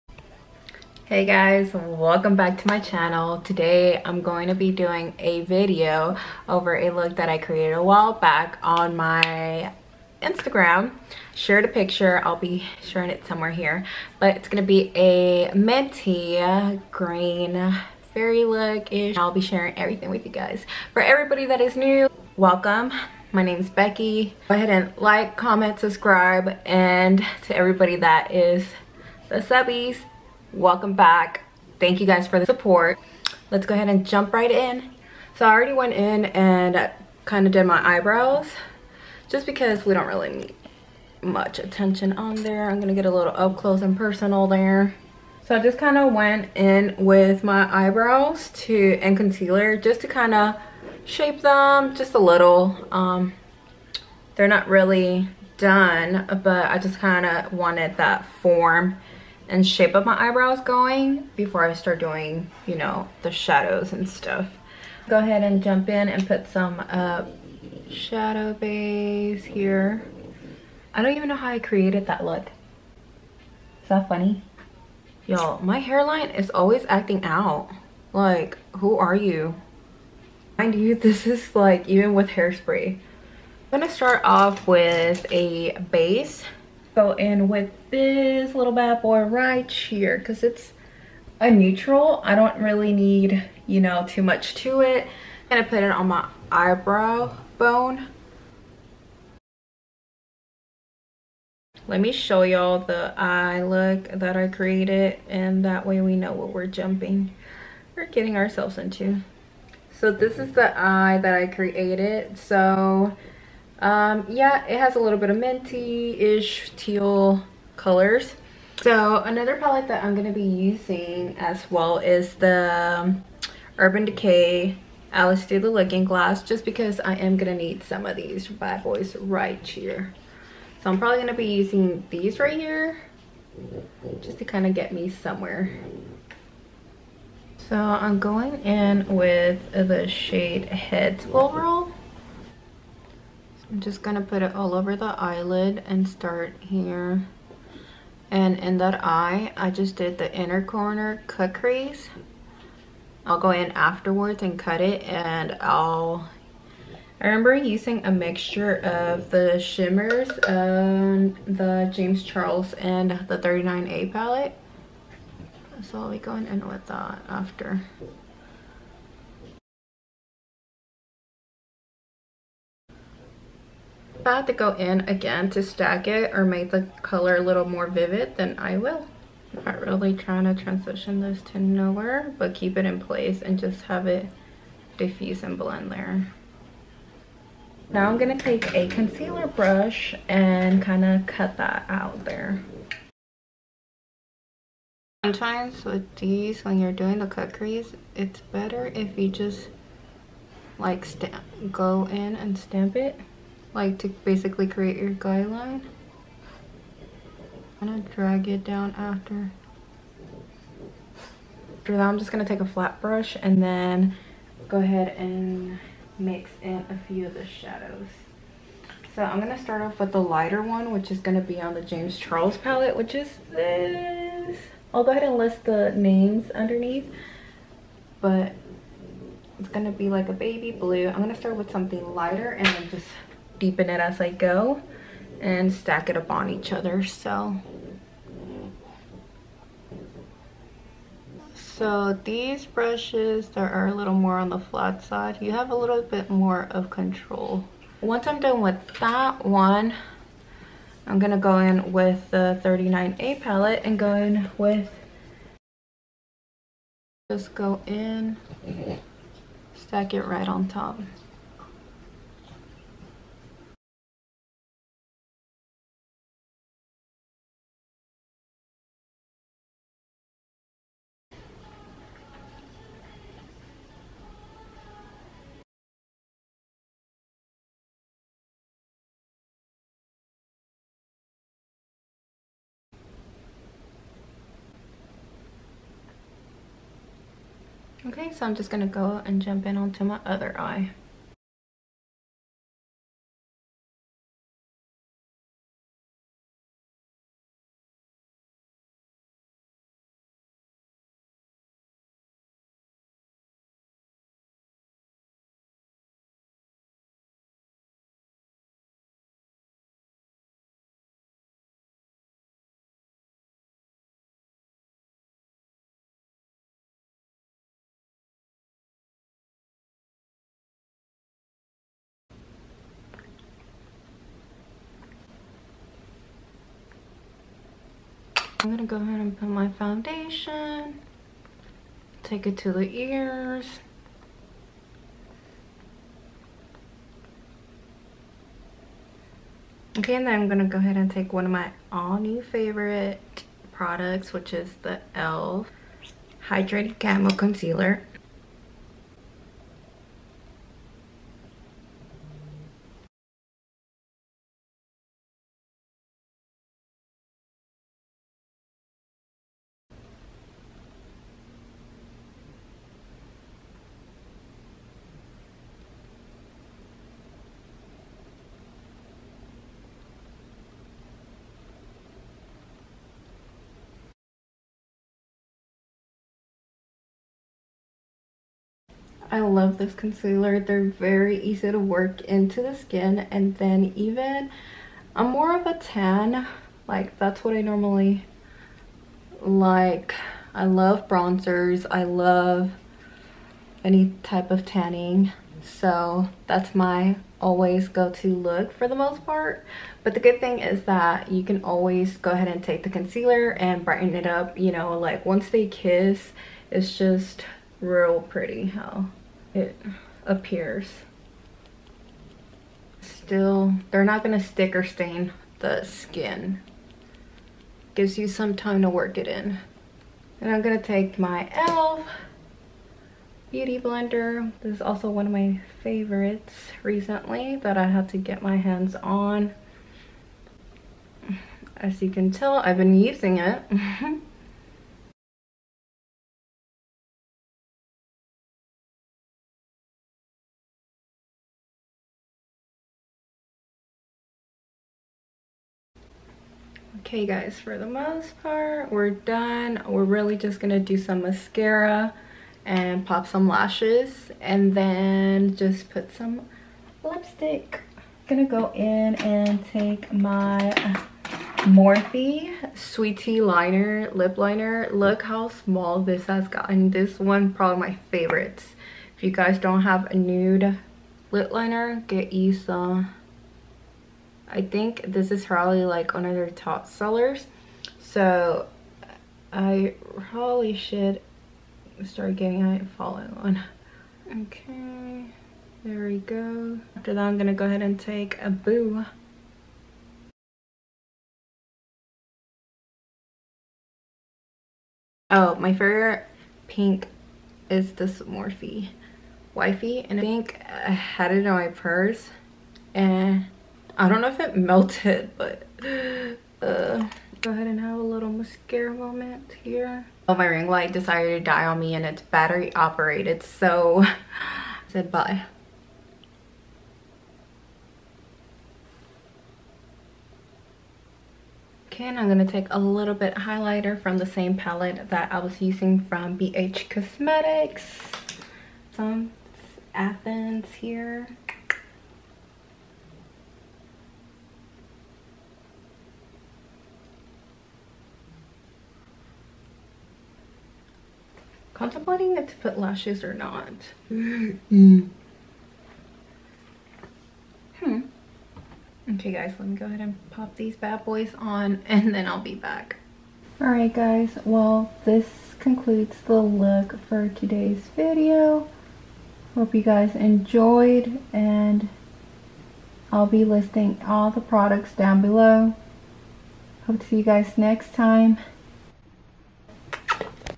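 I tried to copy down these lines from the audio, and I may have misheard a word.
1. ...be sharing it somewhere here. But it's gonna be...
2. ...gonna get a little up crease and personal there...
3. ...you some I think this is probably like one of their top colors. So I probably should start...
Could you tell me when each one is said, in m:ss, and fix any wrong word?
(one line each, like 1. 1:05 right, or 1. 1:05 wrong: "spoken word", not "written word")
1. 0:12 right
2. 0:42 wrong: "close", not "crease"
3. 7:52 wrong: "sellers", not "colors".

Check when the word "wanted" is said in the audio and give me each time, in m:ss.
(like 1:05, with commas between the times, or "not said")
0:57.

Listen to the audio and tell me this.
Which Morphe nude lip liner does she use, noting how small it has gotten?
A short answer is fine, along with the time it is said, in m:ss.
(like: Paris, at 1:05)
Sweet Tea, at 7:42.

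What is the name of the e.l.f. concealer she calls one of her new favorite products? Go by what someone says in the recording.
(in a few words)
Hydrated Camo Concealer.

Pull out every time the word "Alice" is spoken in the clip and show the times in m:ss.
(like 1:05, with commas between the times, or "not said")
2:05.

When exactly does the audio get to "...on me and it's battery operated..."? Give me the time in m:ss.
8:31.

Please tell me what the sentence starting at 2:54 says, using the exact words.
I have to go in again to stack it or make the color a little more vivid, then I will.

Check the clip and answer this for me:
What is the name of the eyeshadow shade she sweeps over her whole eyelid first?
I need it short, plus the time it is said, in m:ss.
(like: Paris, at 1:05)
Heads Will Roll, at 2:20.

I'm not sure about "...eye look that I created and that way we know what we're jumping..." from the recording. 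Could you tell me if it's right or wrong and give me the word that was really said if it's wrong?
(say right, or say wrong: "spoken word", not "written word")
right.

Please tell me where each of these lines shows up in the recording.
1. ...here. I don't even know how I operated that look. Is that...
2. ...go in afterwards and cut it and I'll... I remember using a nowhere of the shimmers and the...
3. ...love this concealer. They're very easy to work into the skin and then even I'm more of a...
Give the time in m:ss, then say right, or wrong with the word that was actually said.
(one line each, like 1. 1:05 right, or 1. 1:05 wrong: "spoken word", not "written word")
1. 1:09 wrong: "created", not "operated"
2. 2:33 wrong: "mixture", not "nowhere"
3. 6:19 right.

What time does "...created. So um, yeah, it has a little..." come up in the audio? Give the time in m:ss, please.
1:51.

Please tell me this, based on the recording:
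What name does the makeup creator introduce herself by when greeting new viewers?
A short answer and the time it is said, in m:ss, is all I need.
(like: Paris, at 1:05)
Becky, at 0:23.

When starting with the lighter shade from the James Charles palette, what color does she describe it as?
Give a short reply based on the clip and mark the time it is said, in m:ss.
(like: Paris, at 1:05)
Baby blue, at 3:50.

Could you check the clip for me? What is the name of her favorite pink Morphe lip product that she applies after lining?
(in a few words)
Wifey.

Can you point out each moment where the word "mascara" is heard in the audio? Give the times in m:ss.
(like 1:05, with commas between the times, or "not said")
7:31, 8:28.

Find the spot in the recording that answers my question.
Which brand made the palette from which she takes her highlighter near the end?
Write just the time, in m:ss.
8:46.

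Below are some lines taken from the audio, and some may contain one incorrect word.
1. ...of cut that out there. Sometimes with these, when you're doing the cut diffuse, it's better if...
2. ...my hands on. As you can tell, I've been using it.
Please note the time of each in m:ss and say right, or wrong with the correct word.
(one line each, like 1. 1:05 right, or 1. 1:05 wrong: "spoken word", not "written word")
1. 3:11 wrong: "crease", not "diffuse"
2. 7:08 right.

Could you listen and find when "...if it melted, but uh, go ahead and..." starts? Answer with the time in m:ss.
8:24.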